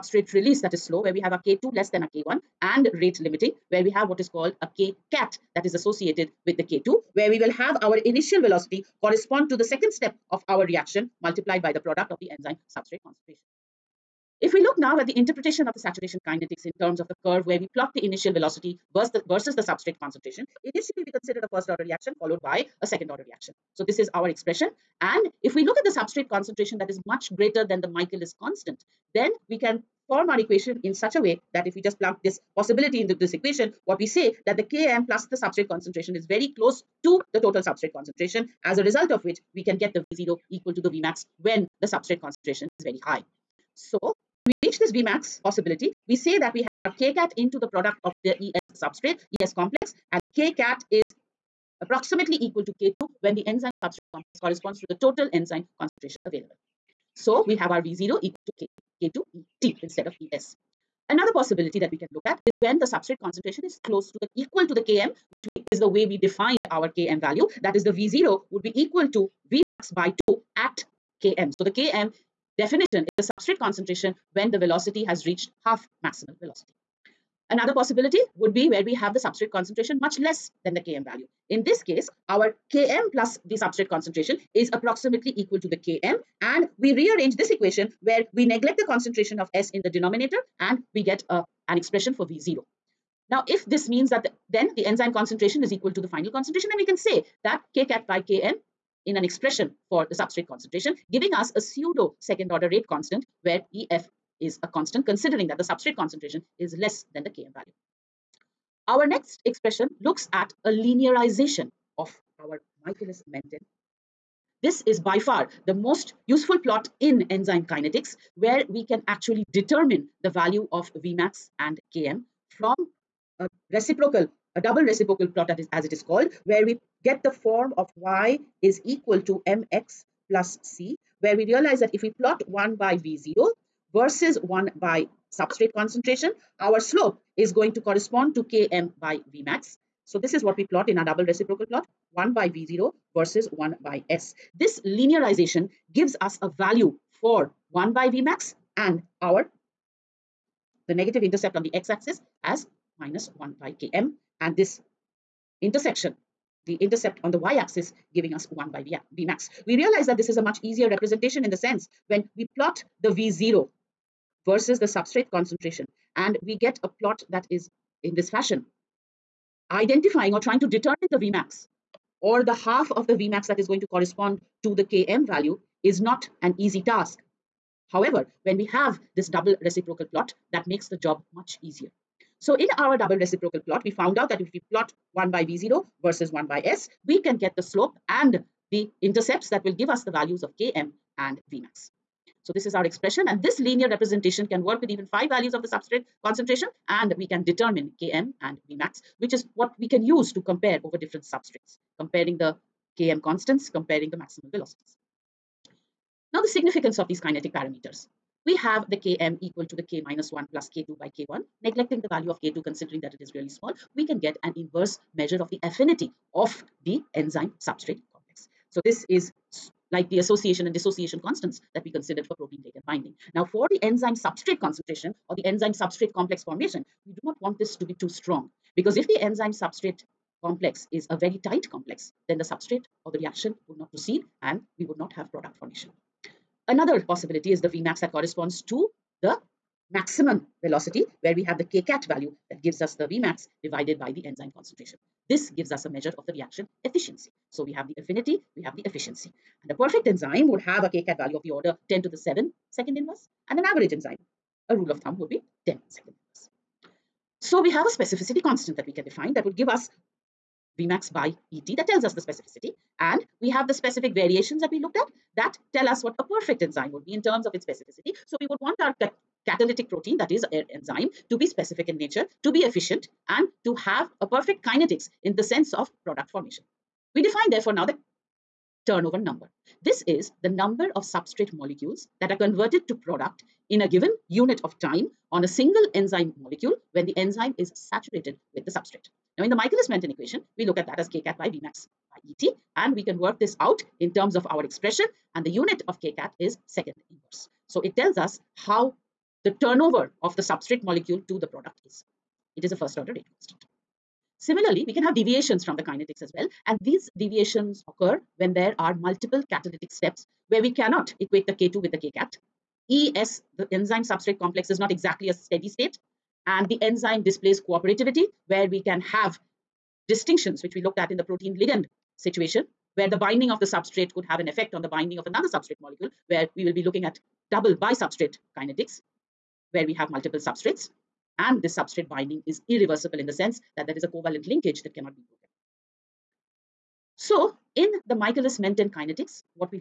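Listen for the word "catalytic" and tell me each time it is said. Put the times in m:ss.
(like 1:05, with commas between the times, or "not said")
4:29, 5:09.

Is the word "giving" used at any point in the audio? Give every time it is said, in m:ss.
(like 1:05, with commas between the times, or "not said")
1:41, 2:38.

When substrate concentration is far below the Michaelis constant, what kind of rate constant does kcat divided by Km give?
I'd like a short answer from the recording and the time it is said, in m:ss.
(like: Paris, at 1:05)
pseudo second order, at 1:41.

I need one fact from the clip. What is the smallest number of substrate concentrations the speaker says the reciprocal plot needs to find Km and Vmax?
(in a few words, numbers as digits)
5.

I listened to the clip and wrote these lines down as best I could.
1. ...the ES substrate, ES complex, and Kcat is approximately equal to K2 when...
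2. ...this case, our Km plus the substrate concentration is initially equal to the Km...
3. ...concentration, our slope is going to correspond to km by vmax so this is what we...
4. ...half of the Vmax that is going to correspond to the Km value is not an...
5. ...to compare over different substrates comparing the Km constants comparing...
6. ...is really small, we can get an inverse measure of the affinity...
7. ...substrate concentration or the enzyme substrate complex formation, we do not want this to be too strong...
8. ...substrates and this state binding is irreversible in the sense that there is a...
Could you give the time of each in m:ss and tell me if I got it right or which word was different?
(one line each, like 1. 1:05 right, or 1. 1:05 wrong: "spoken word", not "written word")
1. 0:48 right
2. 1:21 wrong: "approximately", not "initially"
3. 2:15 right
4. 2:52 right
5. 3:20 right
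6. 3:33 right
7. 3:44 right
8. 5:30 wrong: "substrate", not "state".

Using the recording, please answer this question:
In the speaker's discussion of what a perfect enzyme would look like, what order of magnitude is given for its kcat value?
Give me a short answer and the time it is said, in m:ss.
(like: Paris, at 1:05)
10^7 per second, at 4:11.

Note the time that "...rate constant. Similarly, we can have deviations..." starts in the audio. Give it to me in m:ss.
5:03.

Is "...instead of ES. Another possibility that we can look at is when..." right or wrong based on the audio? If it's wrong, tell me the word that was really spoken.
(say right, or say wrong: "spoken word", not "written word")
right.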